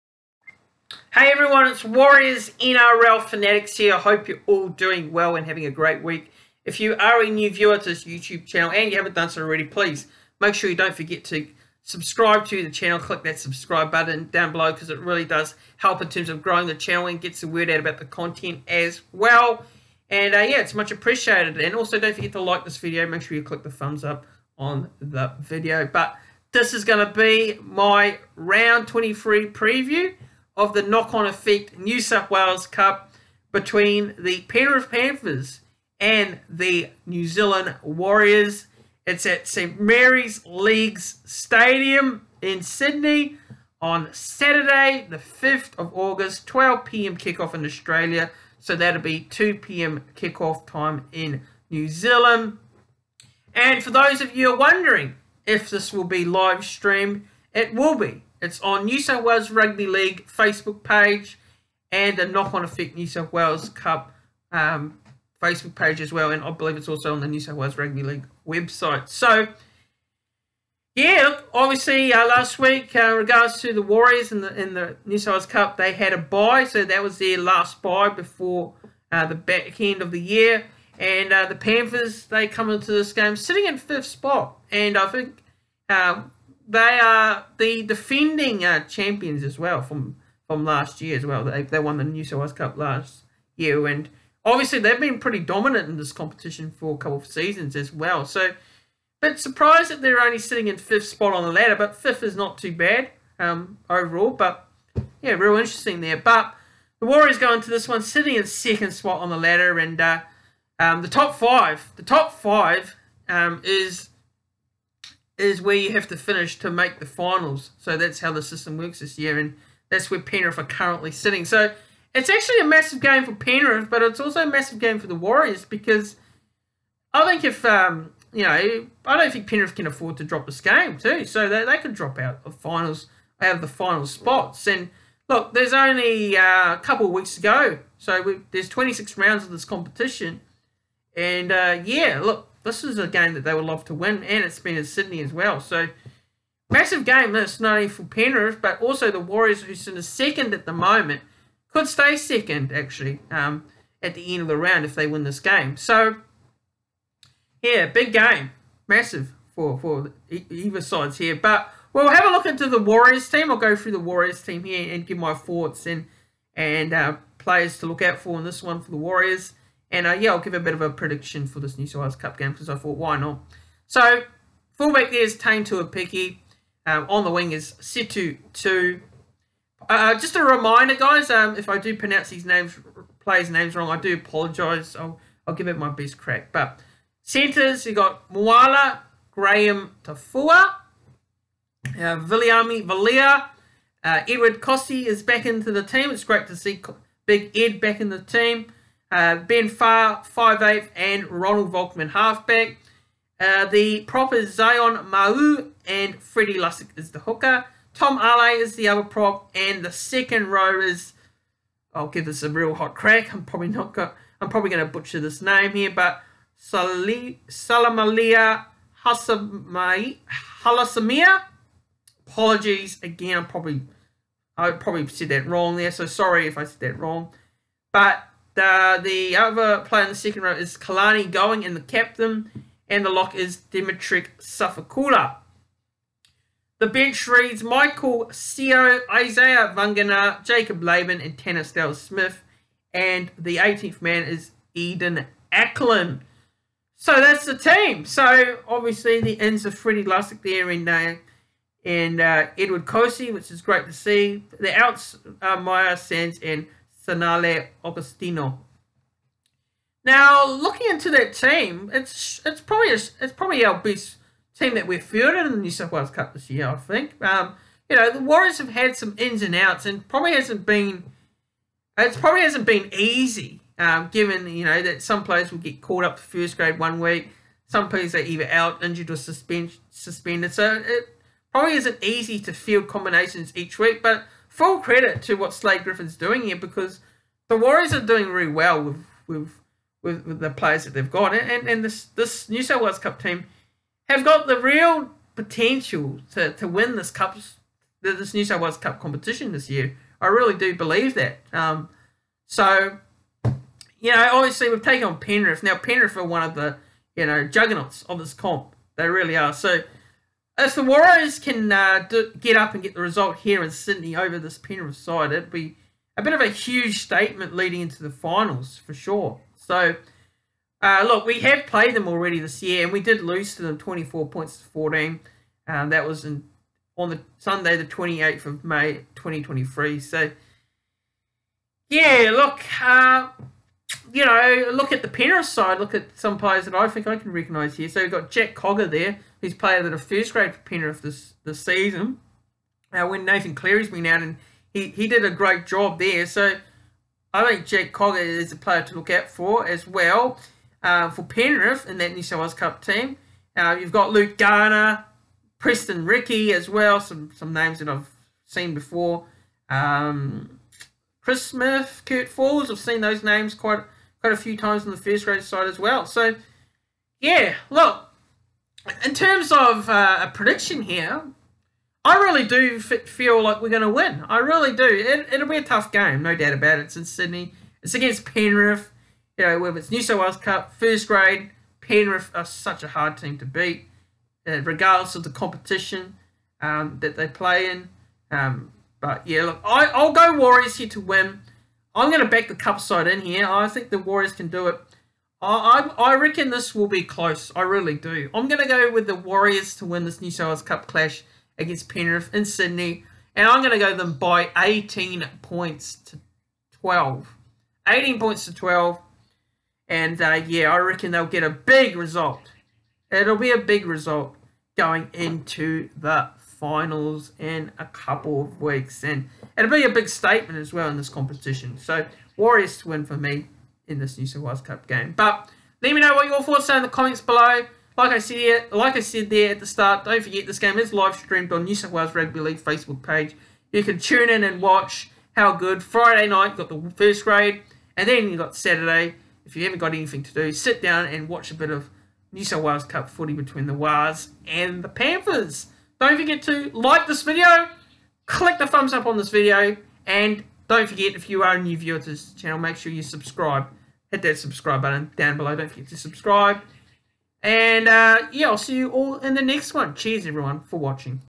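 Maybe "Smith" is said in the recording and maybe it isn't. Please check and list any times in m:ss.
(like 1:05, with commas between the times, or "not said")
4:01, 6:01.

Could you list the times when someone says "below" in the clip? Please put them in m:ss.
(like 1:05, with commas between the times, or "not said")
0:14, 7:07, 7:35.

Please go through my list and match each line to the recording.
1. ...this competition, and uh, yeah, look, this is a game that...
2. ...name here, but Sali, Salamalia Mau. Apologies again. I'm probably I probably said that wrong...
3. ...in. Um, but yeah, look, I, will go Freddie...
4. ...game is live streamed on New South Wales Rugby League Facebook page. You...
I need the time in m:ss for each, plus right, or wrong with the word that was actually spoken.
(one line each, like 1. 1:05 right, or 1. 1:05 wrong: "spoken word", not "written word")
1. 2:19 right
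2. 3:35 wrong: "Halasamia", not "Mau"
3. 6:27 wrong: "Warriors", not "Freddie"
4. 7:10 right.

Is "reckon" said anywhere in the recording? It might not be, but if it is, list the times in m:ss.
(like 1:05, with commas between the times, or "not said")
6:36, 6:50.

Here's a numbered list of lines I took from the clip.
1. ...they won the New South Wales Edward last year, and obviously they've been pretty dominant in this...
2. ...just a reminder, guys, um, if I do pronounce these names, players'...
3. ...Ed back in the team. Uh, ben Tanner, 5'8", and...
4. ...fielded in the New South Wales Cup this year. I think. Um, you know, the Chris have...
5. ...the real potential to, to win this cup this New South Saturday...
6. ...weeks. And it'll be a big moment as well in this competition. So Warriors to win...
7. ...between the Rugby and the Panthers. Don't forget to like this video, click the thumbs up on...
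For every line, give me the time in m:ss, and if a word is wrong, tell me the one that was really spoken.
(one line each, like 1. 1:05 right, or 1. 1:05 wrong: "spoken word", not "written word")
1. 1:31 wrong: "Cup", not "Edward"
2. 3:00 right
3. 3:17 wrong: "Farr", not "Tanner"
4. 4:25 wrong: "Warriors", not "Chris"
5. 4:54 wrong: "Wales", not "Saturday"
6. 6:58 wrong: "statement", not "moment"
7. 7:23 wrong: "Wars", not "Rugby".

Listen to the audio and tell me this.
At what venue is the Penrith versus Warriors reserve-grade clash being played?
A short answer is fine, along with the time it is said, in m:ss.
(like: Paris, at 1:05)
St Mary's Leagues Stadium, at 0:39.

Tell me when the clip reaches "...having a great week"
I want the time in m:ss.
0:05.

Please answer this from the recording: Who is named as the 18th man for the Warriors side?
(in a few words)
Eden Acklin.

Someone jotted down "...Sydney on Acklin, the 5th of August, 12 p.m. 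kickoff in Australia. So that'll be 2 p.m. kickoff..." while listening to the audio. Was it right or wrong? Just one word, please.
wrong.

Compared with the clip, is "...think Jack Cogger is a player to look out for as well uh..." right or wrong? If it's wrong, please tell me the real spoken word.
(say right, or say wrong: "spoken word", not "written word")
right.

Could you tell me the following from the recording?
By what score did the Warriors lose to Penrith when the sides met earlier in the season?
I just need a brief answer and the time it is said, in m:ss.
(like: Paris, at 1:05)
24 to 14, at 5:23.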